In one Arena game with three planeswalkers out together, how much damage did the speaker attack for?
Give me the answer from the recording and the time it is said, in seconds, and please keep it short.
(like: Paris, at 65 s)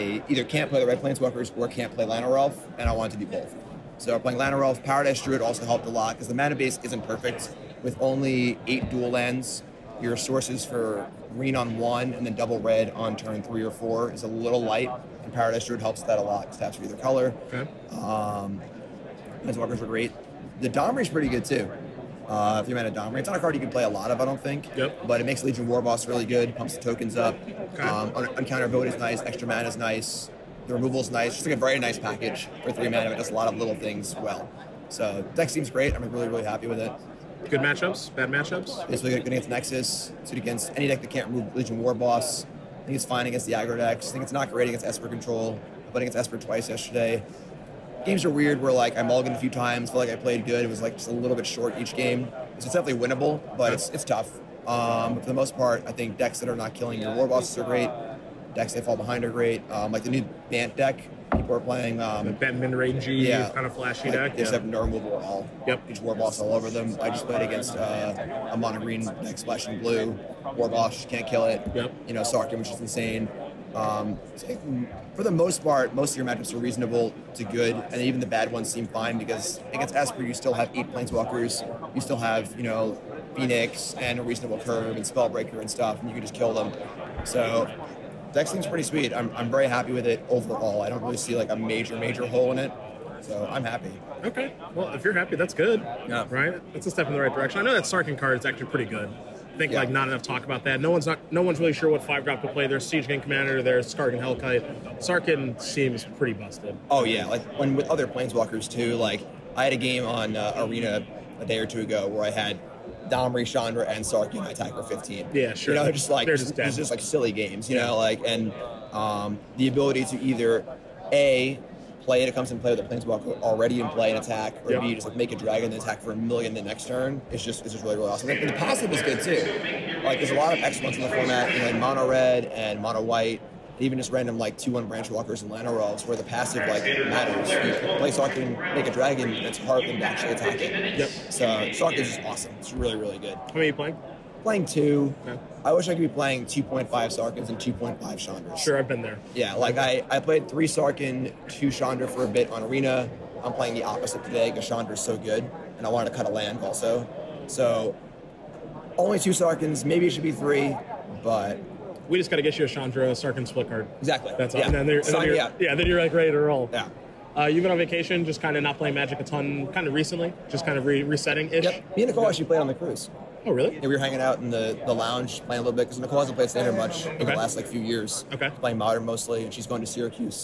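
15, at 114 s.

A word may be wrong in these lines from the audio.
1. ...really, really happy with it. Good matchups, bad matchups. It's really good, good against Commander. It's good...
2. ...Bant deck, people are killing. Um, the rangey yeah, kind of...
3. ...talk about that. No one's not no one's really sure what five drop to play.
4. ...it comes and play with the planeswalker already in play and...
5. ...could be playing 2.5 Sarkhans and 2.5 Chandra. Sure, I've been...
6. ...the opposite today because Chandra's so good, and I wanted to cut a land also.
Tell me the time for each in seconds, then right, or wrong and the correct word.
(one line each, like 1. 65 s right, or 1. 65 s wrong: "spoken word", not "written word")
1. 36 s wrong: "Nexus", not "Commander"
2. 60 s wrong: "playing", not "killing"
3. 100 s right
4. 122 s right
5. 145 s right
6. 153 s right.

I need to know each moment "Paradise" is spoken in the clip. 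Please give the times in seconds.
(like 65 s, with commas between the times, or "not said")
4 s, 15 s.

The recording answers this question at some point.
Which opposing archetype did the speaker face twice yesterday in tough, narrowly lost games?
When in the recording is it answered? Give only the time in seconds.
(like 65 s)
44 s.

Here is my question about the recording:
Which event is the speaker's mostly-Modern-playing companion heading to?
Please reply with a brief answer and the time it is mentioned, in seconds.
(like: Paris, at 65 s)
Syracuse, at 179 s.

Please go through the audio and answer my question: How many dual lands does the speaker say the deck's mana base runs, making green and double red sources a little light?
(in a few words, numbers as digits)
8.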